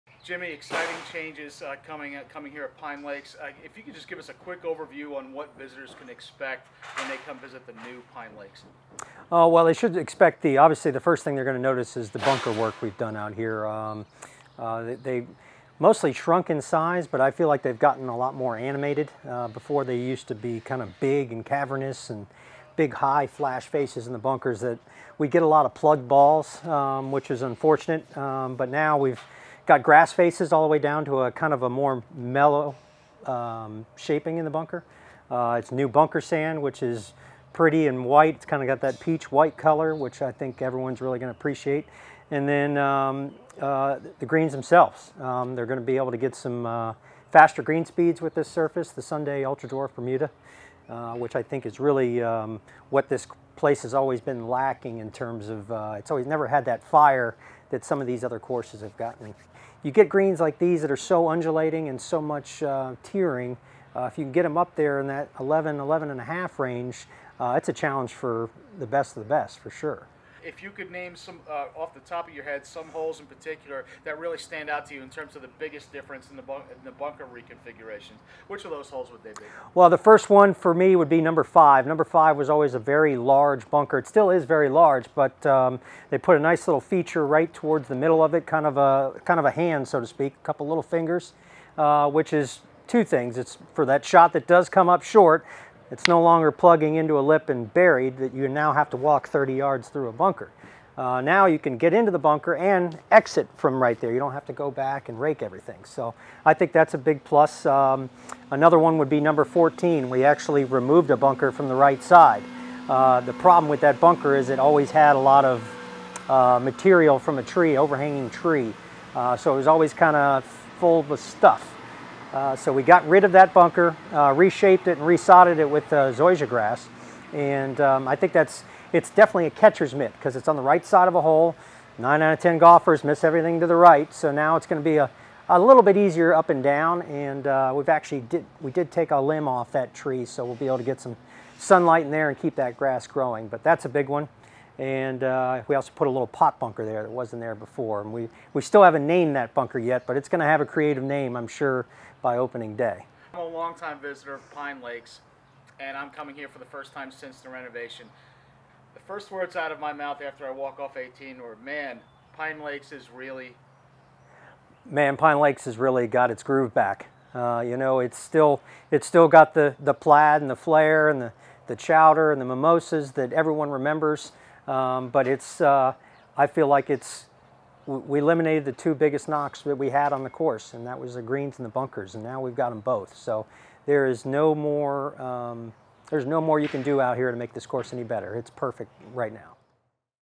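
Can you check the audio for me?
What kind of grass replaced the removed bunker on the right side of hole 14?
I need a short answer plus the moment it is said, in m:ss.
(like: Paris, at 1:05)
zoysia, at 2:06.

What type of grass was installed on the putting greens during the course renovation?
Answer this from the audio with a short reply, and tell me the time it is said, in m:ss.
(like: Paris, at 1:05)
Sunday Ultra Dwarf Bermuda, at 0:49.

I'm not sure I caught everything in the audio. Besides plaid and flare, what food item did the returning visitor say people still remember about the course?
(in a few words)
chowder.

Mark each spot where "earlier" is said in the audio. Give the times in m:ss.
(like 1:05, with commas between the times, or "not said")
not said.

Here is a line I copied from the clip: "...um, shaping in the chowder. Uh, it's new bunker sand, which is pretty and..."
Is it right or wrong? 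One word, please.
wrong.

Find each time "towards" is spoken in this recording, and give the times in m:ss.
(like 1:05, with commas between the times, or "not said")
1:27.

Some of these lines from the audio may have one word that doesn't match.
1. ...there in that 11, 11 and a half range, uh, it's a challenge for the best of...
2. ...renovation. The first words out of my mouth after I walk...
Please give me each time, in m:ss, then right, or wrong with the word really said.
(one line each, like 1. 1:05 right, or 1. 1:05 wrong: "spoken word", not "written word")
1. 1:04 right
2. 2:37 right.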